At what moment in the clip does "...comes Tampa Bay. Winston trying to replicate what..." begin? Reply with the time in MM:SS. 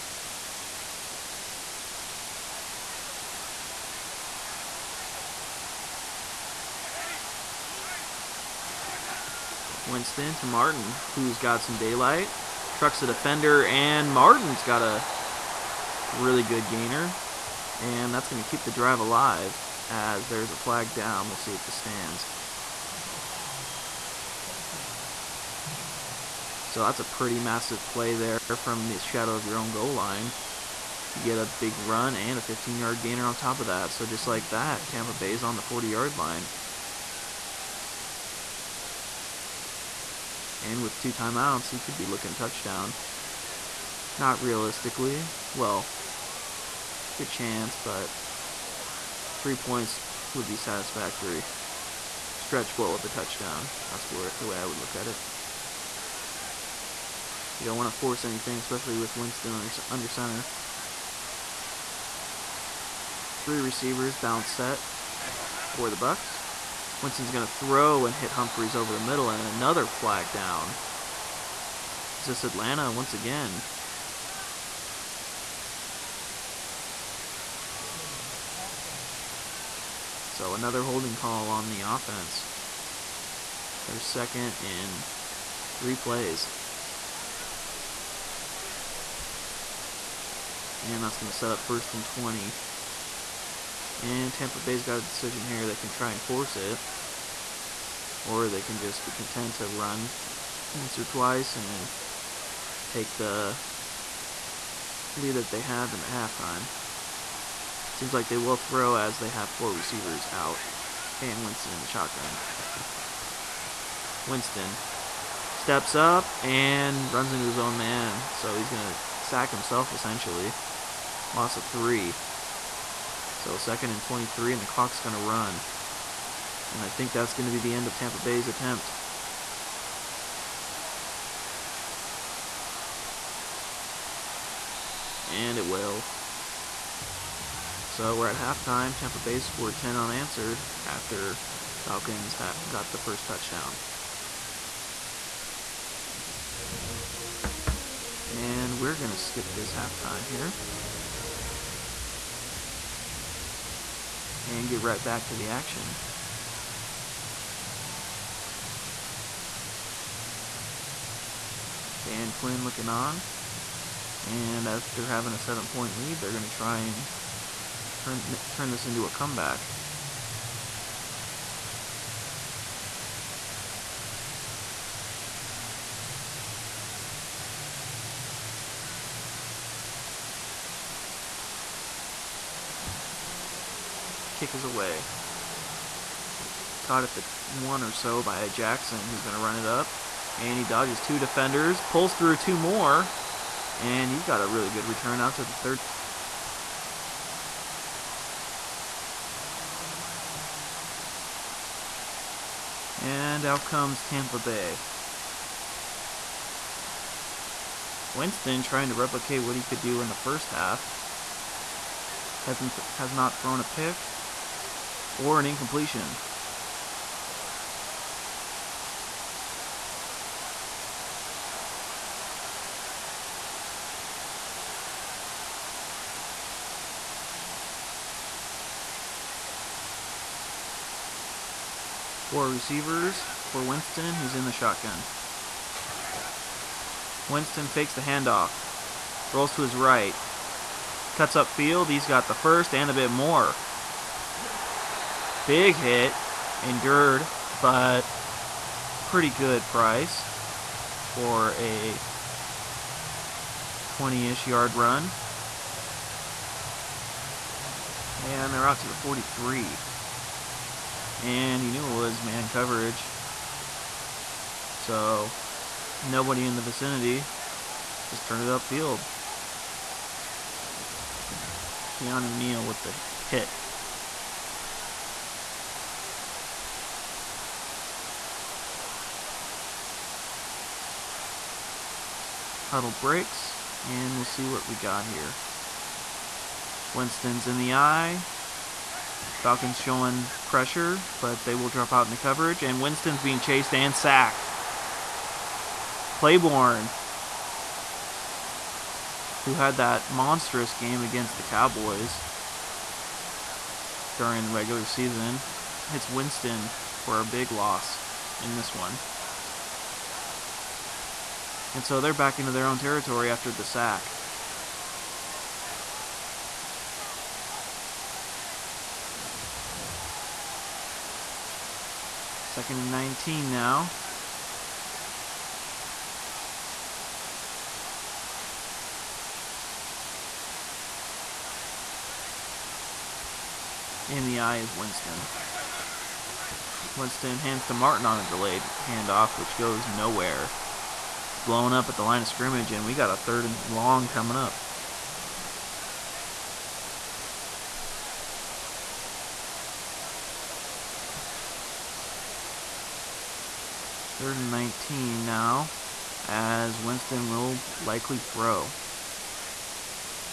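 03:23.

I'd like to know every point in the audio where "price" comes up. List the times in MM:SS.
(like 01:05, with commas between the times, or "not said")
04:09.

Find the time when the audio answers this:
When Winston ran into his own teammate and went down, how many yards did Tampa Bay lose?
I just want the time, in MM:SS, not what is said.
02:01.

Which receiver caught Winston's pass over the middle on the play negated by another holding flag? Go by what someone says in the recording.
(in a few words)
Humphries.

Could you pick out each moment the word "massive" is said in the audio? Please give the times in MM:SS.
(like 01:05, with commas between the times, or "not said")
00:27.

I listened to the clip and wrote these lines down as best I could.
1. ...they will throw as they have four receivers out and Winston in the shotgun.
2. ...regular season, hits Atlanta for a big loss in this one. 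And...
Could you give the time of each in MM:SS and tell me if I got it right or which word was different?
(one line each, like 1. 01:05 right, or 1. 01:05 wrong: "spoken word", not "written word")
1. 01:48 right
2. 05:04 wrong: "Winston", not "Atlanta".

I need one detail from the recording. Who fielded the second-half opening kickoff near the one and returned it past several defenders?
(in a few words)
Jackson.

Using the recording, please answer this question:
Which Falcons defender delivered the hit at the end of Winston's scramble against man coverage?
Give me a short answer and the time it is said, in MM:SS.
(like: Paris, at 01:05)
Keanu Neal, at 04:31.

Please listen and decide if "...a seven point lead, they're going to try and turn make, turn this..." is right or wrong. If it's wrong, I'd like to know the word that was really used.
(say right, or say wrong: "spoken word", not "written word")
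right.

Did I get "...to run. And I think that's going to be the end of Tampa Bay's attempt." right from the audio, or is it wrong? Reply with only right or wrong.
right.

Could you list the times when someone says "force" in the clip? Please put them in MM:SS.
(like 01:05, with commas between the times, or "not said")
00:57, 01:36.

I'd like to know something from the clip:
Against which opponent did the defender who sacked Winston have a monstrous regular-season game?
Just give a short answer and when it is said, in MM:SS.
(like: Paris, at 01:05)
Cowboys, at 05:01.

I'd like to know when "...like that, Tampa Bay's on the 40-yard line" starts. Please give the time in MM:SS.
00:34.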